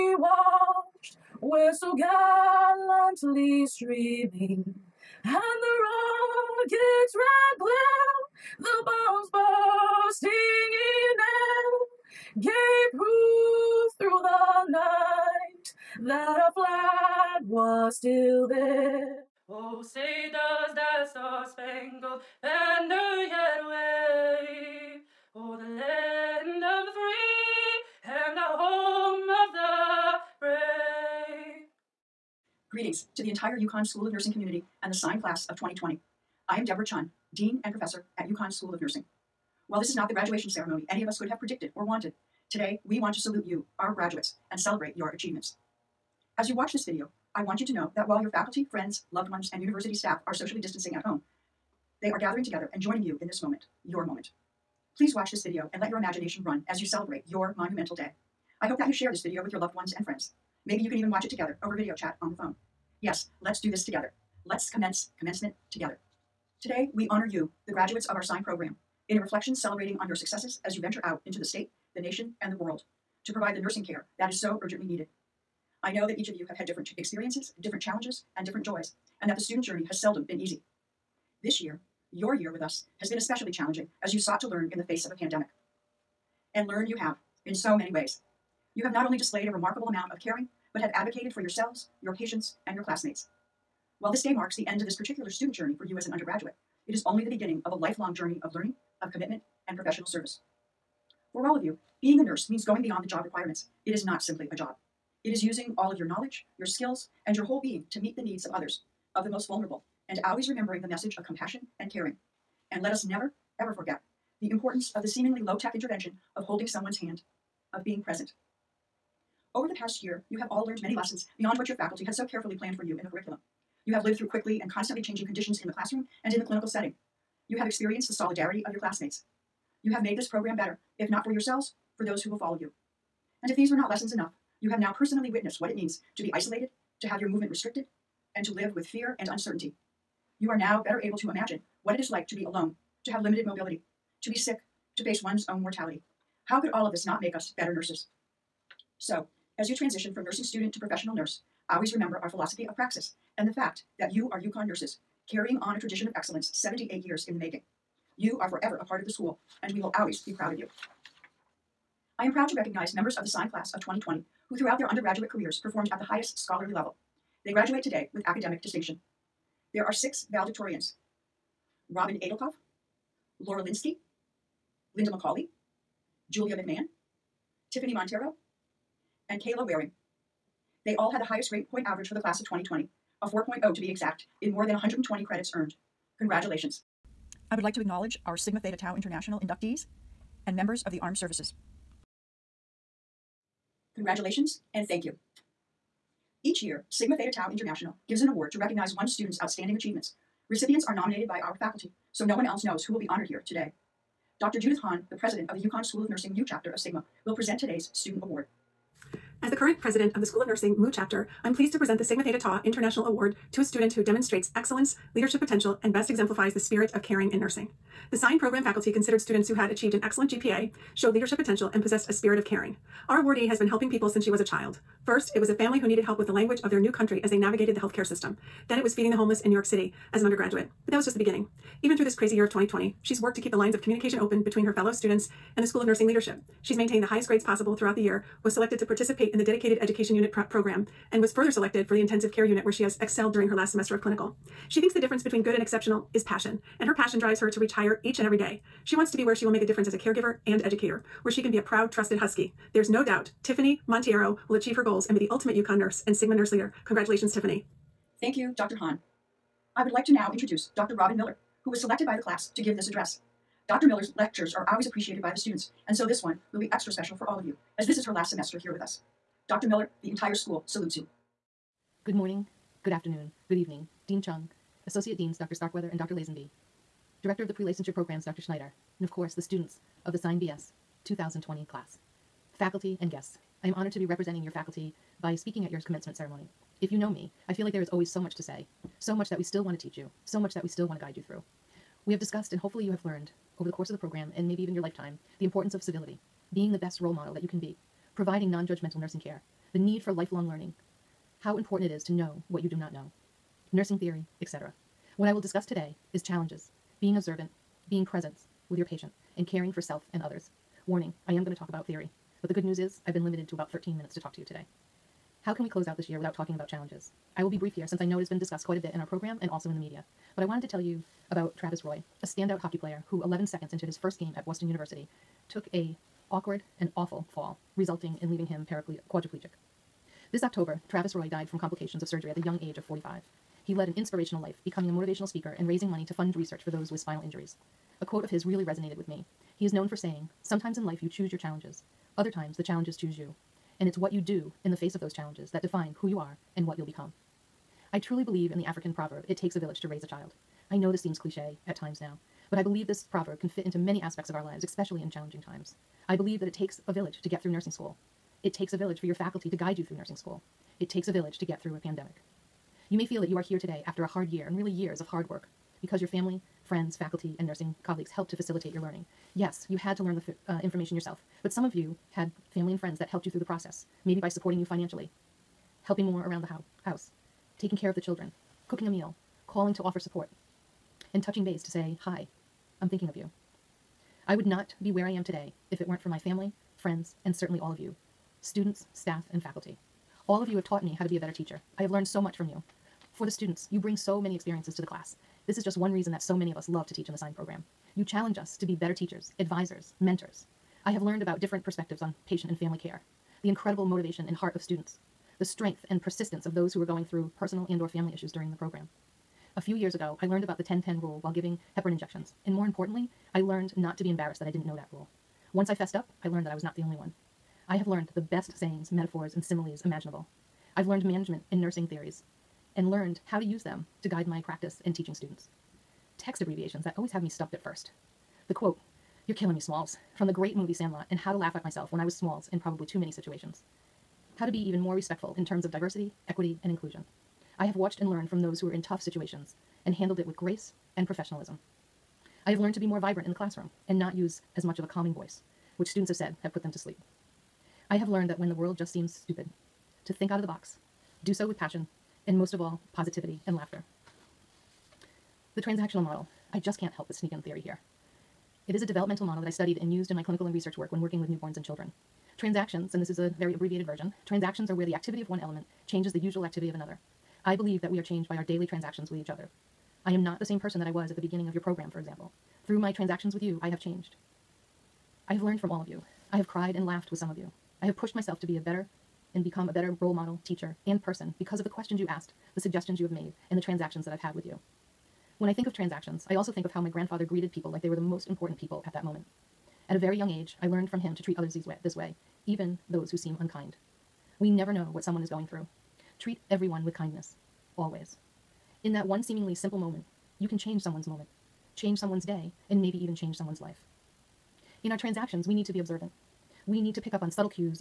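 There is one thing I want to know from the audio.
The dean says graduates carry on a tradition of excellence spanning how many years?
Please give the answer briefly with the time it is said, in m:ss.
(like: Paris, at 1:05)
78, at 2:36.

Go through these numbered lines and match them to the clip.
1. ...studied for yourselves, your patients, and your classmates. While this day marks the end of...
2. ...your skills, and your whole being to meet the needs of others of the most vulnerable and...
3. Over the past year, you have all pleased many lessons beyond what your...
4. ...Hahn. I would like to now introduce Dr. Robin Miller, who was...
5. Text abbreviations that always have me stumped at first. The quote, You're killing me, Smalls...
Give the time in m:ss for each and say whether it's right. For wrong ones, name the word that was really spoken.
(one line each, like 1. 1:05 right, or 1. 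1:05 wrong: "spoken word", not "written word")
1. 1:30 wrong: "advocated", not "studied"
2. 1:46 right
3. 1:59 wrong: "learned", not "pleased"
4. 4:18 right
5. 7:06 right.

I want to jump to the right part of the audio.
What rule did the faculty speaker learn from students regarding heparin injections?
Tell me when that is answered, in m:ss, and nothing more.
6:50.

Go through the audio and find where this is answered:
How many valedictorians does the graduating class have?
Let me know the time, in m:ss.
2:49.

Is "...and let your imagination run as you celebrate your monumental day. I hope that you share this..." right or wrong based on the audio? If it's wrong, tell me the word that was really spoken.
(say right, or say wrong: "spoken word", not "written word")
right.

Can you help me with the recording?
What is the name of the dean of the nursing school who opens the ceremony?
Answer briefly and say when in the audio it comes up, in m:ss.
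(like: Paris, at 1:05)
Deborah Chyun, at 0:36.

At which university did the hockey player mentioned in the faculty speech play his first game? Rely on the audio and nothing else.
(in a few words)
Boston University.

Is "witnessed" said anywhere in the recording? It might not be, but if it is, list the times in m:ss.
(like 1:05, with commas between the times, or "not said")
2:15.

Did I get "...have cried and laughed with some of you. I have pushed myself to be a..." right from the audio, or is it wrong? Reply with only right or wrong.
right.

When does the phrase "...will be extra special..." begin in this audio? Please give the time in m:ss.
4:26.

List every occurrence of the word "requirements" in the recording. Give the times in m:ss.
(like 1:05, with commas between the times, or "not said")
1:43.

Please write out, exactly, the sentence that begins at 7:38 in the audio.
It is a developmental model that I studied and used in my clinical and research work when working with newborns and children.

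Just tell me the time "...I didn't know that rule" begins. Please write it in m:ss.
6:54.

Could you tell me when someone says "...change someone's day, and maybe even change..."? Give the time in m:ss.
8:21.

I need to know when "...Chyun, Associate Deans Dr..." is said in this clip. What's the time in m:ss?
4:34.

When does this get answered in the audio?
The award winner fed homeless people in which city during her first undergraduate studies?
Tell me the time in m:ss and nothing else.
3:49.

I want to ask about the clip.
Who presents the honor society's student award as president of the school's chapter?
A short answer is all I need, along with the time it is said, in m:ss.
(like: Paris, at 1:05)
Judith Hahn, at 3:24.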